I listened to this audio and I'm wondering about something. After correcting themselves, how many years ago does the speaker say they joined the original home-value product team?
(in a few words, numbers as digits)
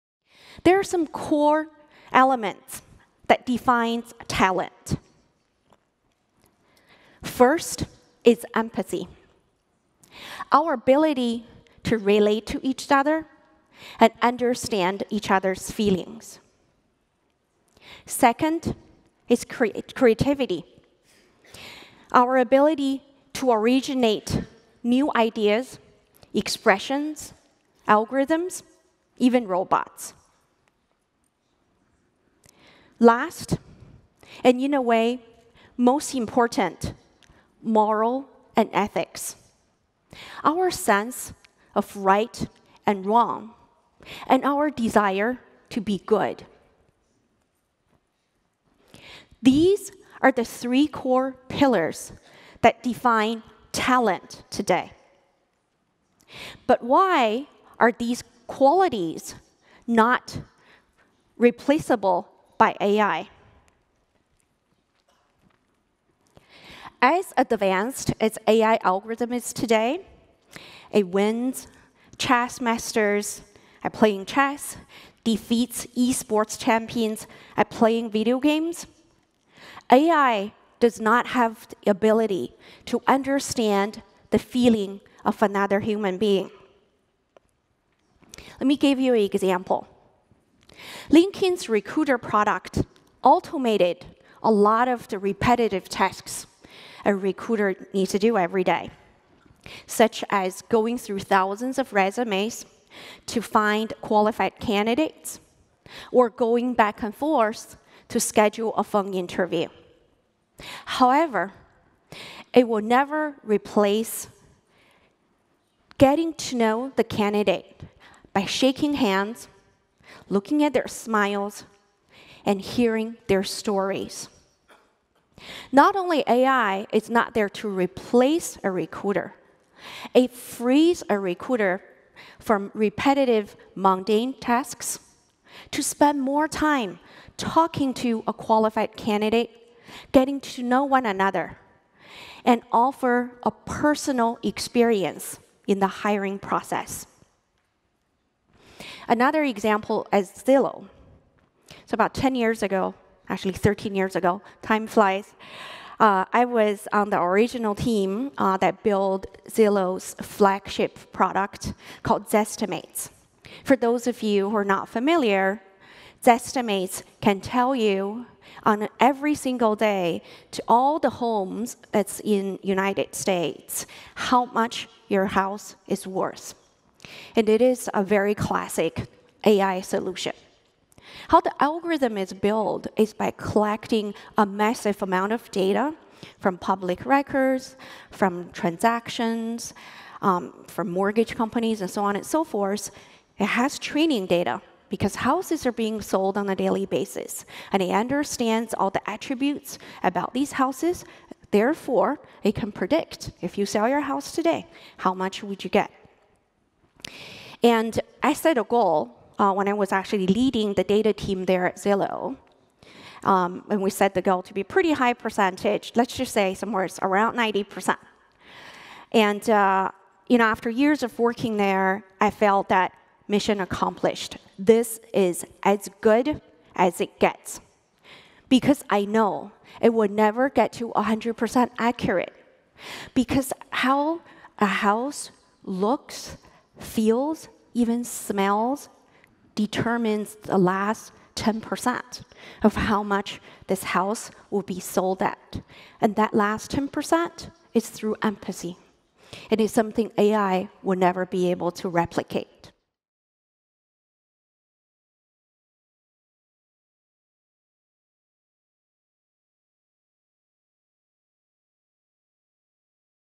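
13.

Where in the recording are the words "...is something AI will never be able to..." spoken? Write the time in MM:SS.
04:09.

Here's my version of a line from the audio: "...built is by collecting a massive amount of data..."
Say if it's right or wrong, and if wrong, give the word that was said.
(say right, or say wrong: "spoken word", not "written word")
right.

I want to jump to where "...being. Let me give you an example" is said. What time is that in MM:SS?
01:26.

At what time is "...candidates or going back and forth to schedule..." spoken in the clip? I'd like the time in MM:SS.
01:44.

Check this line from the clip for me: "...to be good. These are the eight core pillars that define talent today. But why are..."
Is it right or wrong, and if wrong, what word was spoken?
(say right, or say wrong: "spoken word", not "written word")
wrong: "three", not "eight".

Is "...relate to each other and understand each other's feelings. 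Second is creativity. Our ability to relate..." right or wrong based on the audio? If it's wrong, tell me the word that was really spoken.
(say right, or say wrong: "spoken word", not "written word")
wrong: "originate", not "relate".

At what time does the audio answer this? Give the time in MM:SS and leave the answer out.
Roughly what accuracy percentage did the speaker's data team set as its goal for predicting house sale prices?
03:37.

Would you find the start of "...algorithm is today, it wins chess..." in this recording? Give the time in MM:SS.
01:08.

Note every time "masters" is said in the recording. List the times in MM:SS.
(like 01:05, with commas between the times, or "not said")
01:12.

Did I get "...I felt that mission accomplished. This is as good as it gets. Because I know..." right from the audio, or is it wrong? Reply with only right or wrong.
right.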